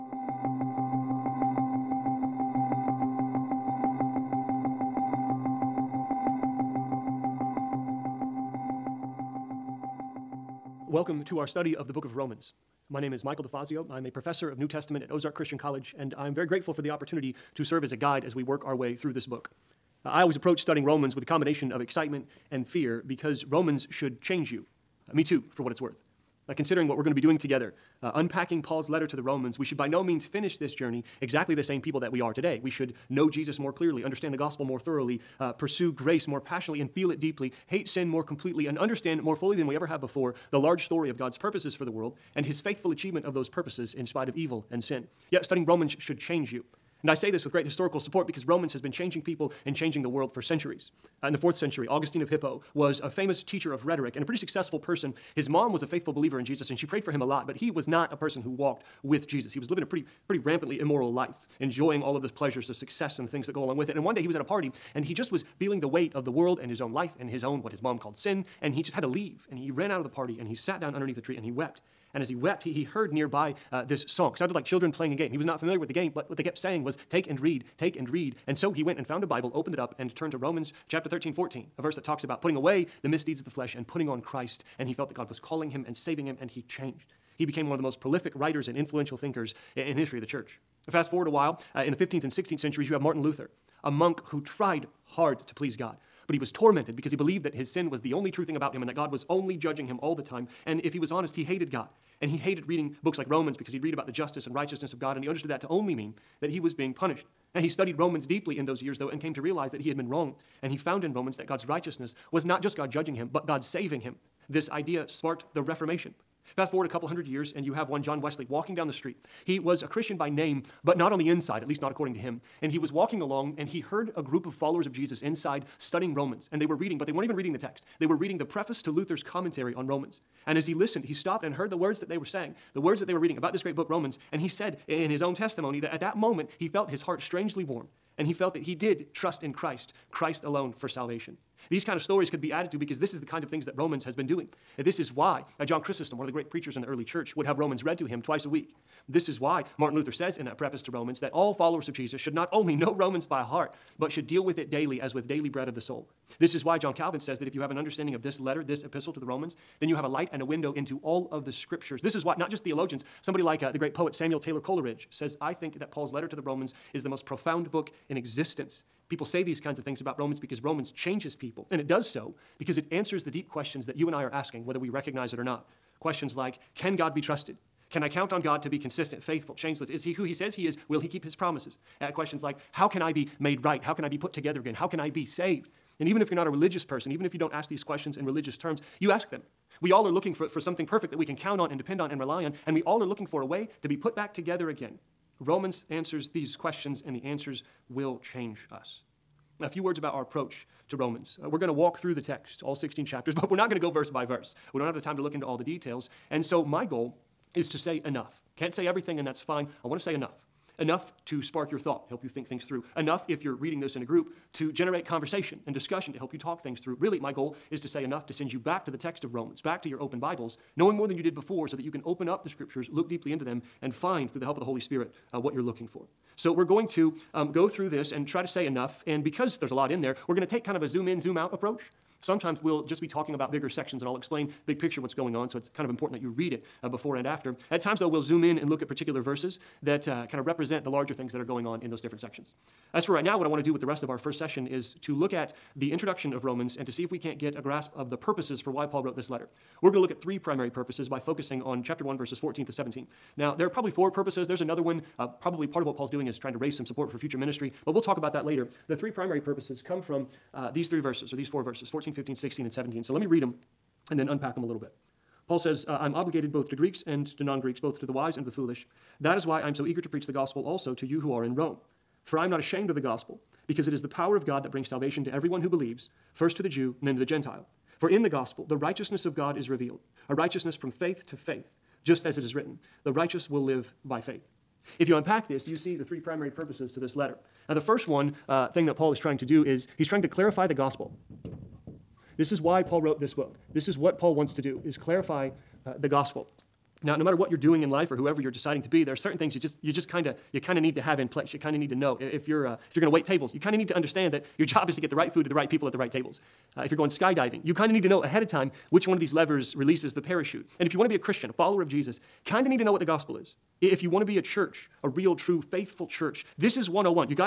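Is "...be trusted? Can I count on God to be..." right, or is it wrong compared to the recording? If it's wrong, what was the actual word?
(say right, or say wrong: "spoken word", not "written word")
right.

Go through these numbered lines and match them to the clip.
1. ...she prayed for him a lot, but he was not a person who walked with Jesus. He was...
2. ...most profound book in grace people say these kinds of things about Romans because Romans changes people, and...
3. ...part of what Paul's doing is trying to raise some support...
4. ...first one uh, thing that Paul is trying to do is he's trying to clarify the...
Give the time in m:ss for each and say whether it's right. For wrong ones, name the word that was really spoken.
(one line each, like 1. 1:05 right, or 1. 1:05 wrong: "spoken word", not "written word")
1. 0:56 right
2. 2:47 wrong: "existence", not "grace"
3. 4:15 right
4. 4:47 right.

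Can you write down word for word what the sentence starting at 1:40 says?
And if he was honest, he hated God.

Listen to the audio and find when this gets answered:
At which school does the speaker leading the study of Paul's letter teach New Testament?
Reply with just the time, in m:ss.
0:15.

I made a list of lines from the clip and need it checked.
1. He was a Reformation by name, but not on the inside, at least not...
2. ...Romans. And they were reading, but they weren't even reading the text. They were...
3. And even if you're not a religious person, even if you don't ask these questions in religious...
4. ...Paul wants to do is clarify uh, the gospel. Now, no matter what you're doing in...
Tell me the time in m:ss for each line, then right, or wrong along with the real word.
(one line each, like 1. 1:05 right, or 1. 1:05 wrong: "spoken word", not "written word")
1. 1:59 wrong: "Christian", not "Reformation"
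2. 2:06 right
3. 3:06 right
4. 4:54 right.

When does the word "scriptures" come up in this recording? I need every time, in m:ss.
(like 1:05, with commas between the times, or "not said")
2:41, 3:42.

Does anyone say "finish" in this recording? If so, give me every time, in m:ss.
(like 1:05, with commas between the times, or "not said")
0:30.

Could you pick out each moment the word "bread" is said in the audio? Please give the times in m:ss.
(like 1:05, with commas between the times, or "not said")
2:35.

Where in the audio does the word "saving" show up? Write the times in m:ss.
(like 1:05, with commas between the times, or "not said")
1:25, 1:53.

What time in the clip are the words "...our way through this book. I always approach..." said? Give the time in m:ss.
0:18.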